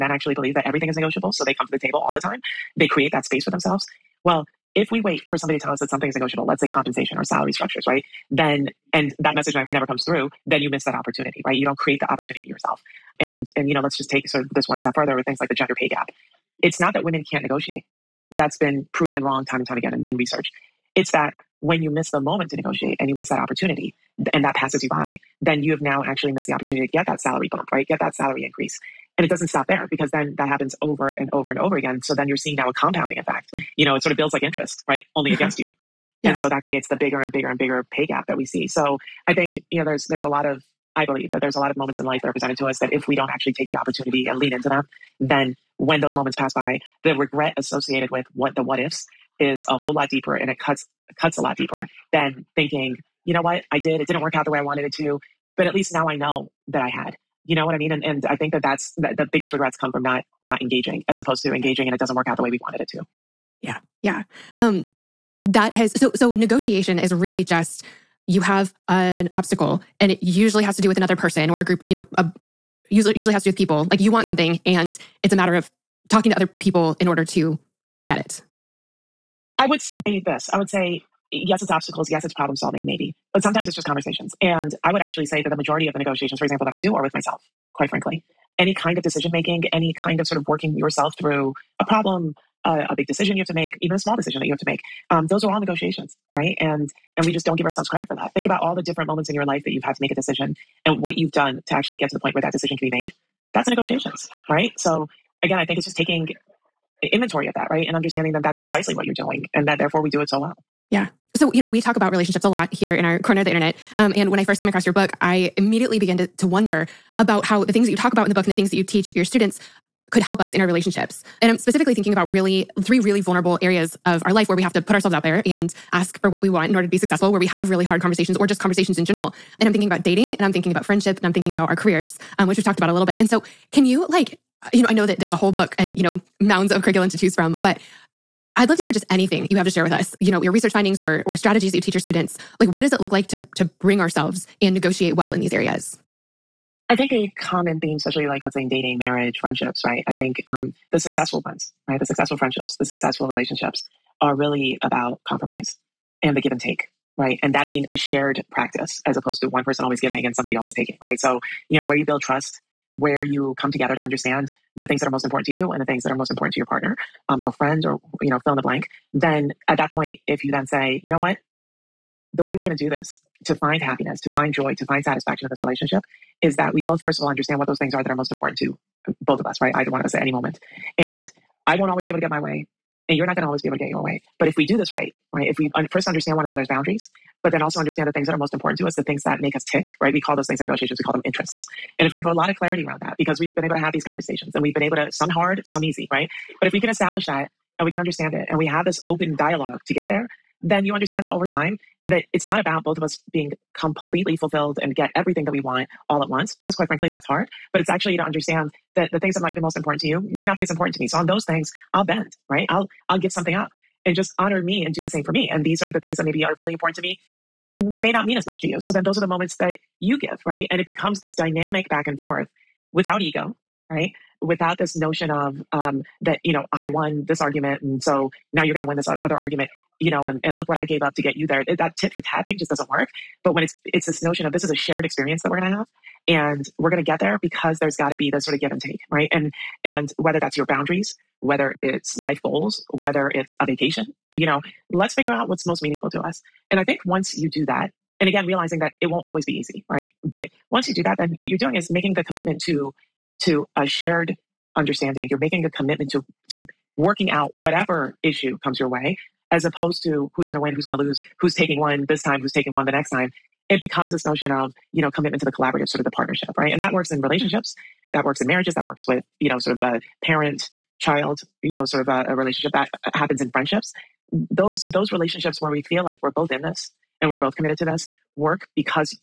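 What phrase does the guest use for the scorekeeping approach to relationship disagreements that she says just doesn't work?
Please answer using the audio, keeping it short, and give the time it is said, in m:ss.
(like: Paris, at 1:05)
Tit for tat, at 3:51.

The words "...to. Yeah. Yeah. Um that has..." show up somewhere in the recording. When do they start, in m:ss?
1:02.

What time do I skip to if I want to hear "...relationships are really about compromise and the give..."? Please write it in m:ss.
2:33.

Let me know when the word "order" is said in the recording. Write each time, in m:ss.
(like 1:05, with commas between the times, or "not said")
1:17, 2:06.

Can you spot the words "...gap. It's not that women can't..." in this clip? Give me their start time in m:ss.
0:15.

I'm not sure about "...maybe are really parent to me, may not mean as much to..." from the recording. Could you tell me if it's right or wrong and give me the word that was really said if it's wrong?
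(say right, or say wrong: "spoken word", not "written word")
wrong: "important", not "parent".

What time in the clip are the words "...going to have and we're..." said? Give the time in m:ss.
3:55.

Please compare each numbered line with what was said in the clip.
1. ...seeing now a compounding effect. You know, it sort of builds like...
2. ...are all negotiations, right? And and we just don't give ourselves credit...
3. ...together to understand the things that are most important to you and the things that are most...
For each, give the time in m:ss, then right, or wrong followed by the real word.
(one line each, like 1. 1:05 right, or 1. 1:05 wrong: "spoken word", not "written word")
1. 0:32 right
2. 1:35 right
3. 2:43 right.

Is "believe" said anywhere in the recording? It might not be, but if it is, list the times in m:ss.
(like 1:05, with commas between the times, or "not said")
0:00, 0:41.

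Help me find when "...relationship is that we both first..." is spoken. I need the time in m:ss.
2:55.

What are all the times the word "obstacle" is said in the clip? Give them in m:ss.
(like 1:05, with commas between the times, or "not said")
1:09, 1:21.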